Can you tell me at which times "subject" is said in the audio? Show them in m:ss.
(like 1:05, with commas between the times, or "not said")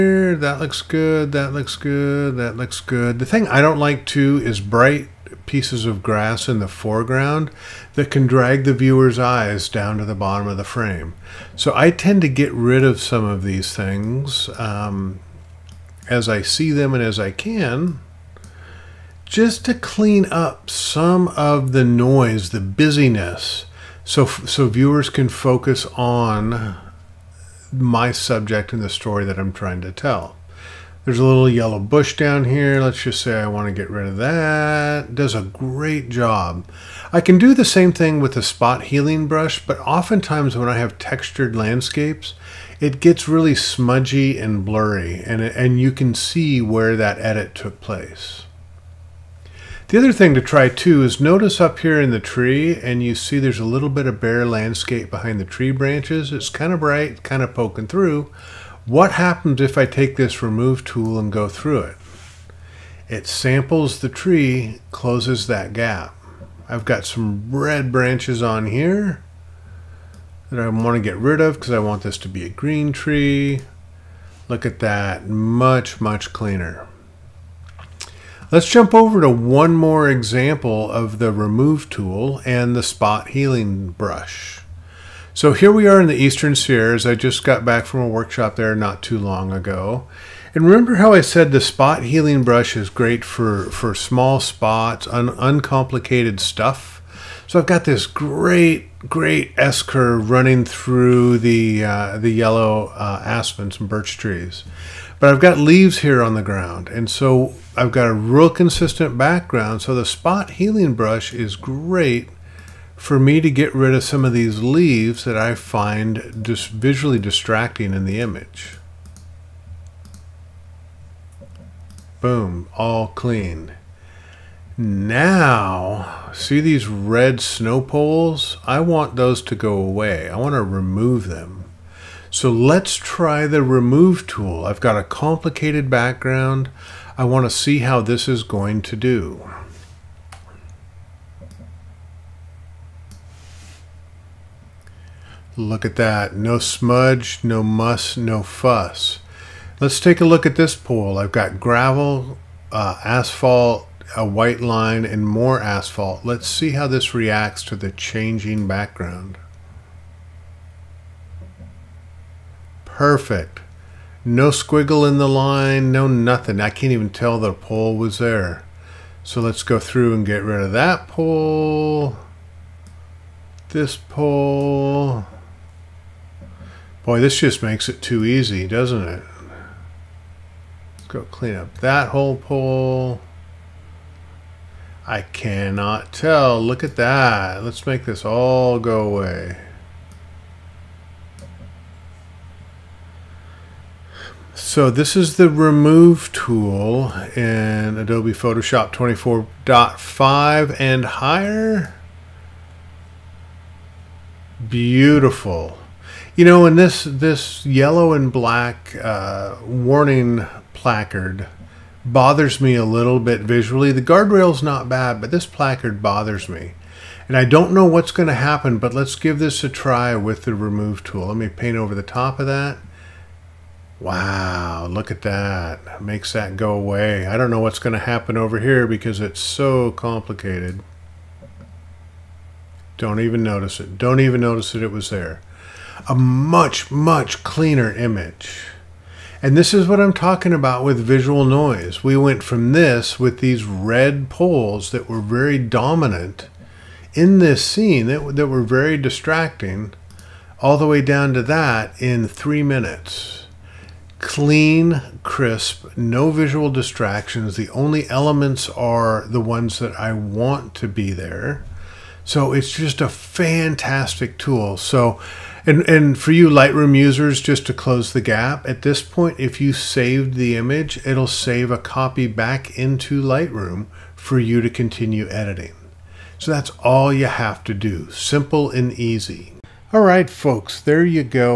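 0:28.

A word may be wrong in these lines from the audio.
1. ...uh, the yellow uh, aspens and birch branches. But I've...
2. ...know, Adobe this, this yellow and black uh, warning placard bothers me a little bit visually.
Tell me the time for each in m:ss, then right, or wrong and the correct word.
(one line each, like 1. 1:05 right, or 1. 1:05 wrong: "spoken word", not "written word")
1. 1:41 wrong: "trees", not "branches"
2. 3:26 wrong: "And", not "Adobe".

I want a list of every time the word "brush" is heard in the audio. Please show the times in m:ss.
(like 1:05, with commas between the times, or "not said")
0:39, 1:23, 1:32, 1:50.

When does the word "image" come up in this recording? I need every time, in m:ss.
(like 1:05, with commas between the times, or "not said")
1:58, 3:57, 4:30.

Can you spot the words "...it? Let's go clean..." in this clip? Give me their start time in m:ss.
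2:59.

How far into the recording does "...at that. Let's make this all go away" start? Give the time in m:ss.
3:06.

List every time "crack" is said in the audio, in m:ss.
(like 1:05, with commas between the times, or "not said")
not said.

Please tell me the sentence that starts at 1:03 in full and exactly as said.
It samples the tree, closes that gap.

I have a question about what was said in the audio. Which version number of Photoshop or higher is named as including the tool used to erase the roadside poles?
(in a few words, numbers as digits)
24.5.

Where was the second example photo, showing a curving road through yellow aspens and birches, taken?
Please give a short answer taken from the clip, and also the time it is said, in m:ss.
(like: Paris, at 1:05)
Eastern Sierras, at 1:26.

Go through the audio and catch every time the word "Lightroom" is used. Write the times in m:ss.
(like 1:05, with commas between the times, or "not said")
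4:26, 4:33.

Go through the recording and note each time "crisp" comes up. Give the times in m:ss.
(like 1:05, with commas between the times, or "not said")
4:15.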